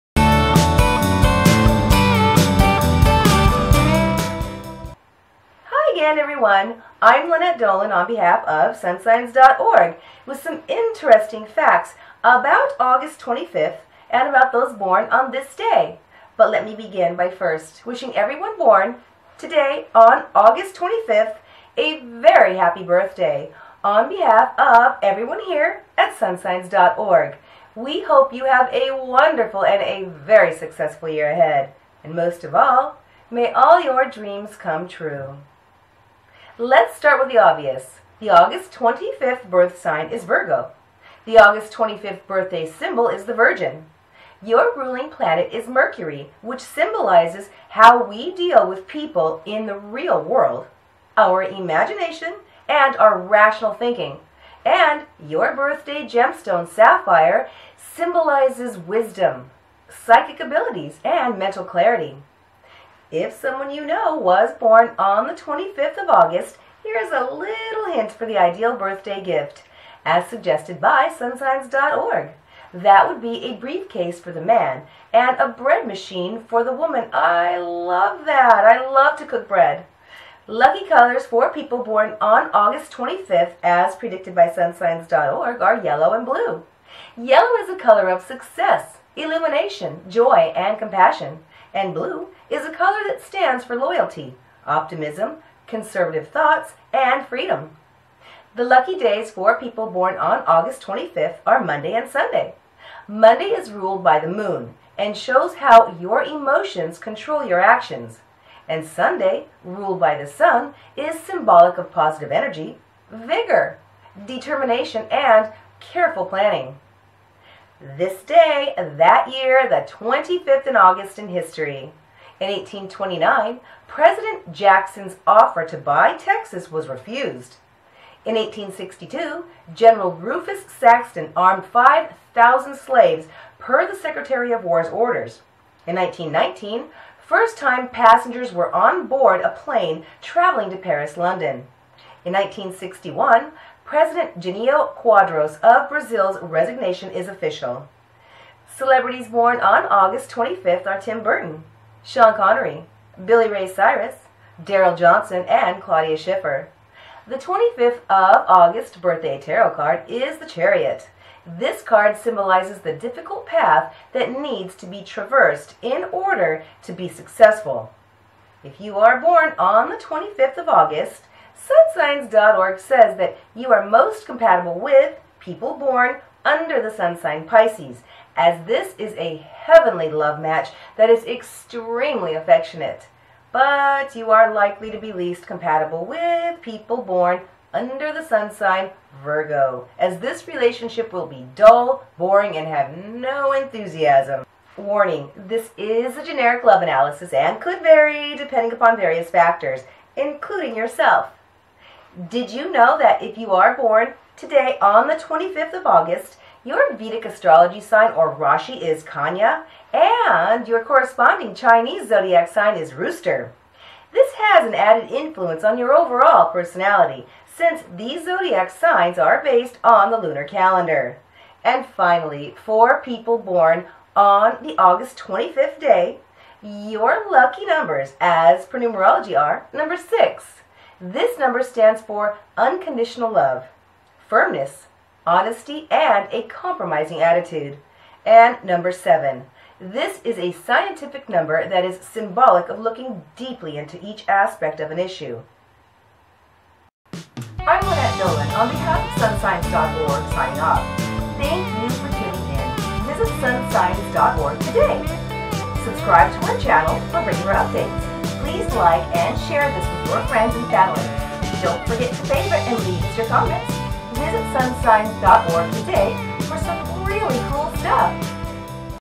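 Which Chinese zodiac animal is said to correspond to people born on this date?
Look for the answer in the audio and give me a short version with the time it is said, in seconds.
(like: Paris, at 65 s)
Rooster, at 212 s.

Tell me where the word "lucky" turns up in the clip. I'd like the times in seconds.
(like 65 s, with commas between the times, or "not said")
80 s, 98 s, 227 s.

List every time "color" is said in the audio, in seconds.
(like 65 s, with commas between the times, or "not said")
80 s, 87 s, 92 s.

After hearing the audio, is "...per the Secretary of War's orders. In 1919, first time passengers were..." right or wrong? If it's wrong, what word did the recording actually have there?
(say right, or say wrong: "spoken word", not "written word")
right.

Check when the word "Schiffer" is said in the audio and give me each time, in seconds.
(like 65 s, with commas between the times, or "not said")
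156 s.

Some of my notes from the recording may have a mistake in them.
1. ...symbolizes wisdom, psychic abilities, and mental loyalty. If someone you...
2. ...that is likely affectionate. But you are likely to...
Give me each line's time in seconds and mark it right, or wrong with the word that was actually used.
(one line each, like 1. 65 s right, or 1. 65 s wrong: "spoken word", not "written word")
1. 57 s wrong: "clarity", not "loyalty"
2. 180 s wrong: "extremely", not "likely".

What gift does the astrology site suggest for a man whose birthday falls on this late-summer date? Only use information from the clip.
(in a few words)
A briefcase.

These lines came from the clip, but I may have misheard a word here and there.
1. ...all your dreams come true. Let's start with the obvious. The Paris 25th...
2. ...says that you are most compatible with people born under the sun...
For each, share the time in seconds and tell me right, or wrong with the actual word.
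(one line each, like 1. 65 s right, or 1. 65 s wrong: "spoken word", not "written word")
1. 33 s wrong: "August", not "Paris"
2. 172 s right.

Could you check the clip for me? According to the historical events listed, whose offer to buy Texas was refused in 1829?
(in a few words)
President Jackson.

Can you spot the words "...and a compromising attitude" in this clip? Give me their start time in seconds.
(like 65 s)
235 s.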